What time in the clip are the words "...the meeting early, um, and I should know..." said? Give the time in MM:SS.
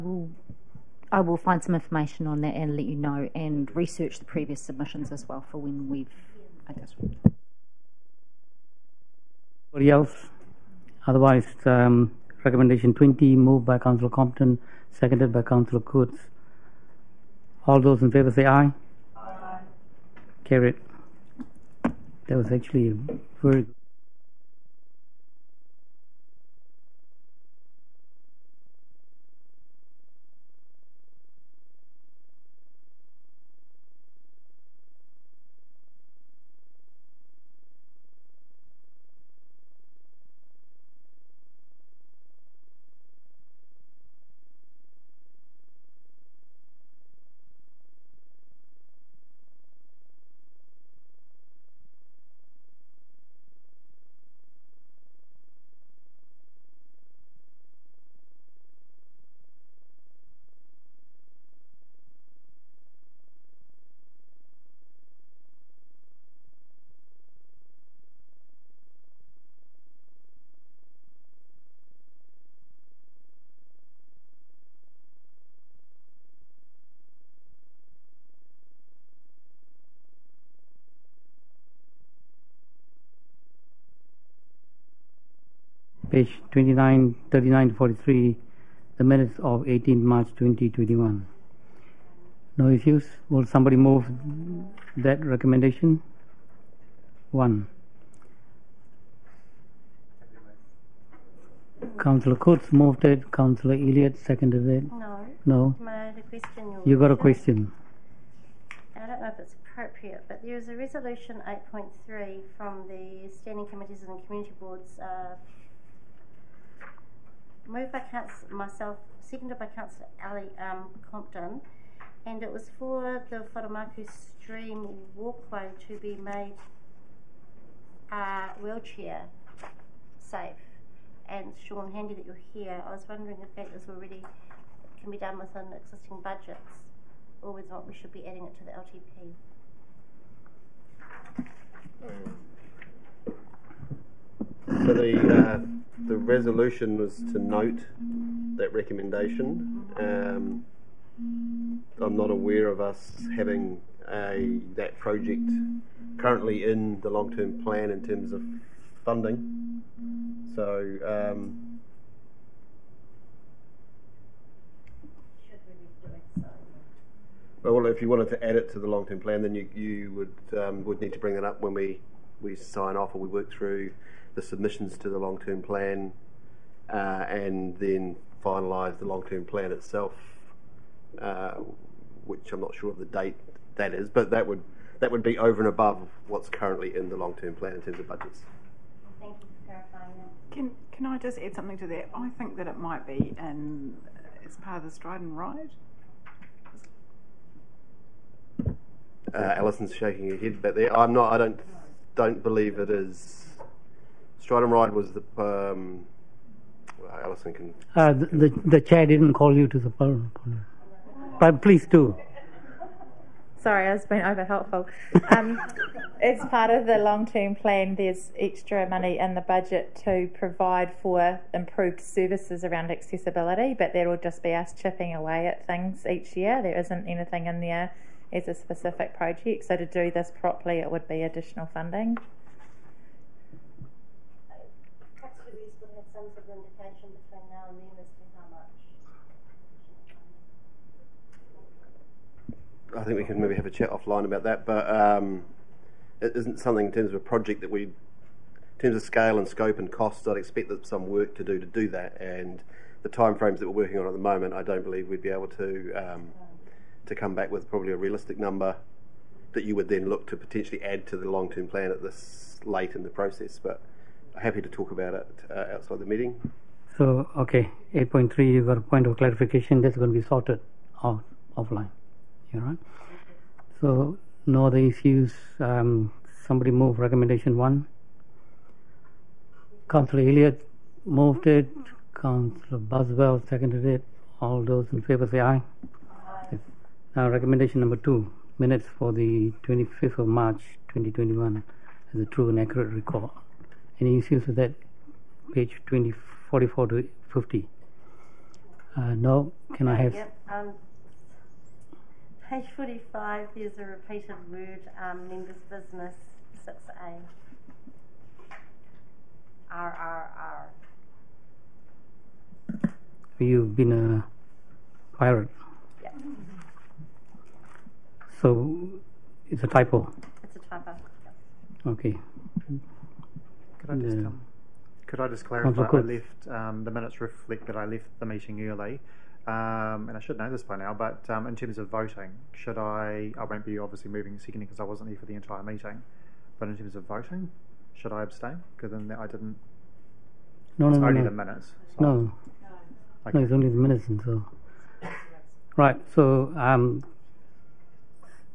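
05:28.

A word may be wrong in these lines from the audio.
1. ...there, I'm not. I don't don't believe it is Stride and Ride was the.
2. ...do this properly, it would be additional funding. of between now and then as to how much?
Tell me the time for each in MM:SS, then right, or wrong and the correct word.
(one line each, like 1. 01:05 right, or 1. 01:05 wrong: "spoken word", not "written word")
1. 03:20 right
2. 03:49 right.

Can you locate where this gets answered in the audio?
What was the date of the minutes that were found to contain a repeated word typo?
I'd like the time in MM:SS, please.
04:49.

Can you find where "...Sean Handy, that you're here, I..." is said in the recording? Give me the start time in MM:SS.
02:11.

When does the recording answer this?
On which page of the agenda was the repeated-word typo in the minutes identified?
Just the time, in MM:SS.
05:02.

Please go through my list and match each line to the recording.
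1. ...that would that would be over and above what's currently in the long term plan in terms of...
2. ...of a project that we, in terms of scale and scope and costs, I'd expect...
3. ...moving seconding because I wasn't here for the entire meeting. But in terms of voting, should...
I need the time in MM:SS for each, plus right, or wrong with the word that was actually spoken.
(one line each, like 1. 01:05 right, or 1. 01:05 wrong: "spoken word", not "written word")
1. 03:04 right
2. 04:07 right
3. 05:34 right.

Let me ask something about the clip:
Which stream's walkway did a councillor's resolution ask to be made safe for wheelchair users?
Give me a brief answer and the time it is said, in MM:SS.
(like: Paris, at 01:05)
Wharemauku Stream, at 02:03.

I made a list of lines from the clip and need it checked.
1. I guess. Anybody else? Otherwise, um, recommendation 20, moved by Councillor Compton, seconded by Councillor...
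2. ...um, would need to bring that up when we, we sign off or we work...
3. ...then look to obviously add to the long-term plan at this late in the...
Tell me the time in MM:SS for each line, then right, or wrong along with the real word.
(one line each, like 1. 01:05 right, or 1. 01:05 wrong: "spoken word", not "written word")
1. 00:06 right
2. 02:50 right
3. 04:19 wrong: "potentially", not "obviously".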